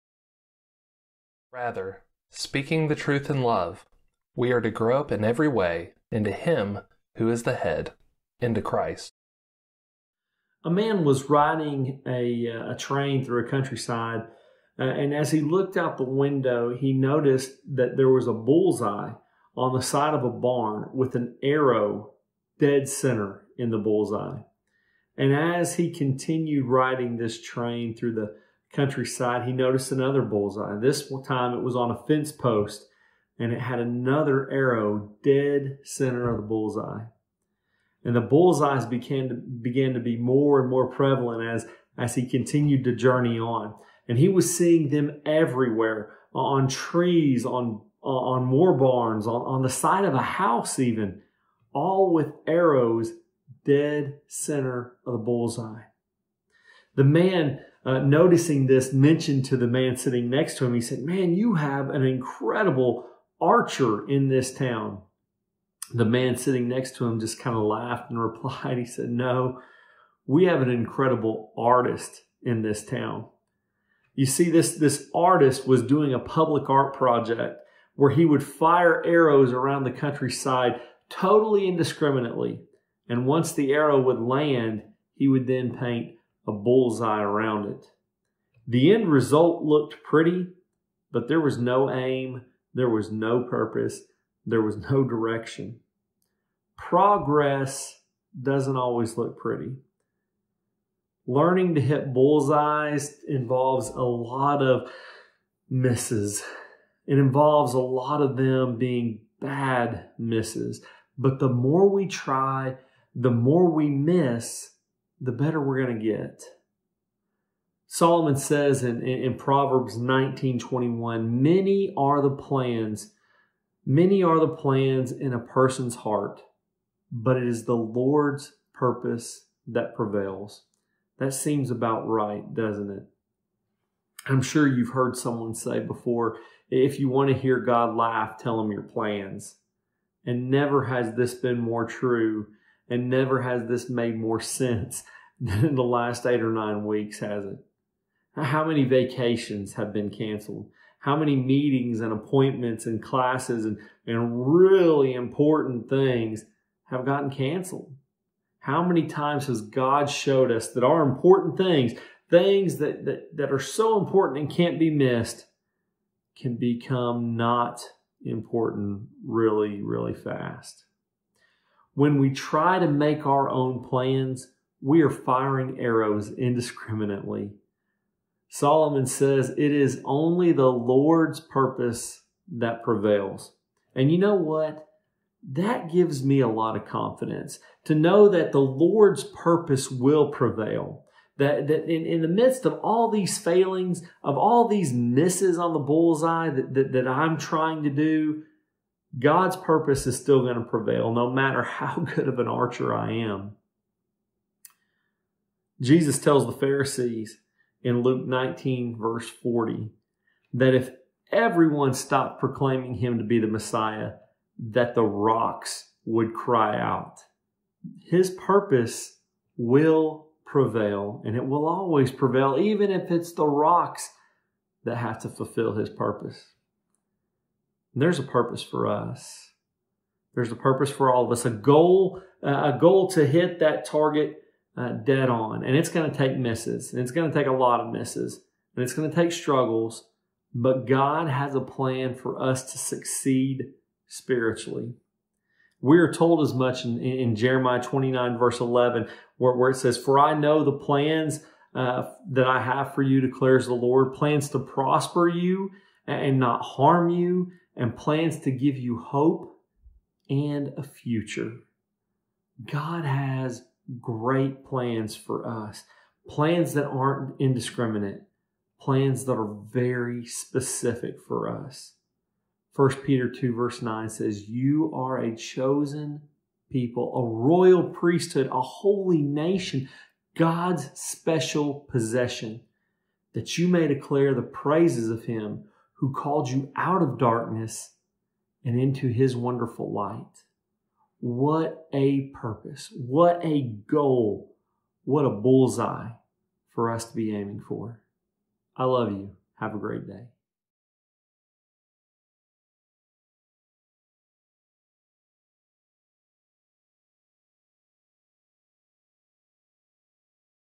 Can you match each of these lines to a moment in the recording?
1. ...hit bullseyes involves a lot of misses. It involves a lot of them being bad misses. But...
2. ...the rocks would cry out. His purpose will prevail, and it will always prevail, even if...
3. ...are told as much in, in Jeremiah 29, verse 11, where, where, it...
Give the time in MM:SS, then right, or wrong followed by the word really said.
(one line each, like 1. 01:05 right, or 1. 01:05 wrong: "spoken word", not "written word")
1. 01:41 right
2. 03:34 right
3. 04:05 right.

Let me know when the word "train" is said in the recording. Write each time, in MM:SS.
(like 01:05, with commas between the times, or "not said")
00:12, 00:27.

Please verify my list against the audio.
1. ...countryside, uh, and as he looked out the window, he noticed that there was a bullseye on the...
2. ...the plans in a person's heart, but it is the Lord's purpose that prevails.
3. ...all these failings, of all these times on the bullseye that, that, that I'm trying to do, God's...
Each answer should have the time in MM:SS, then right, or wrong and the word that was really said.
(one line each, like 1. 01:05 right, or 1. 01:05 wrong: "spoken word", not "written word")
1. 00:13 right
2. 02:04 right
3. 03:12 wrong: "misses", not "times".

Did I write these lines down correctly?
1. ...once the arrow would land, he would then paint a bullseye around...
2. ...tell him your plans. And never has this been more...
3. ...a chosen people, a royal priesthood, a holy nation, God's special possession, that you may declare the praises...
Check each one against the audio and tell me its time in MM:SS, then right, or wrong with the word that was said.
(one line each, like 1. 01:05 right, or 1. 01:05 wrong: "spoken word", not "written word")
1. 01:23 right
2. 02:18 right
3. 04:35 right.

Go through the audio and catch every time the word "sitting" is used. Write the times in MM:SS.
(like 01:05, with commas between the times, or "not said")
00:59, 01:06.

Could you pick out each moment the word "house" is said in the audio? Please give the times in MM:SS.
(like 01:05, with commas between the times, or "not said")
00:50.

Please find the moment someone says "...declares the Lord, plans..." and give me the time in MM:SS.
04:13.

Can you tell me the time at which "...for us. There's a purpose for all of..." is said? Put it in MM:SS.
03:48.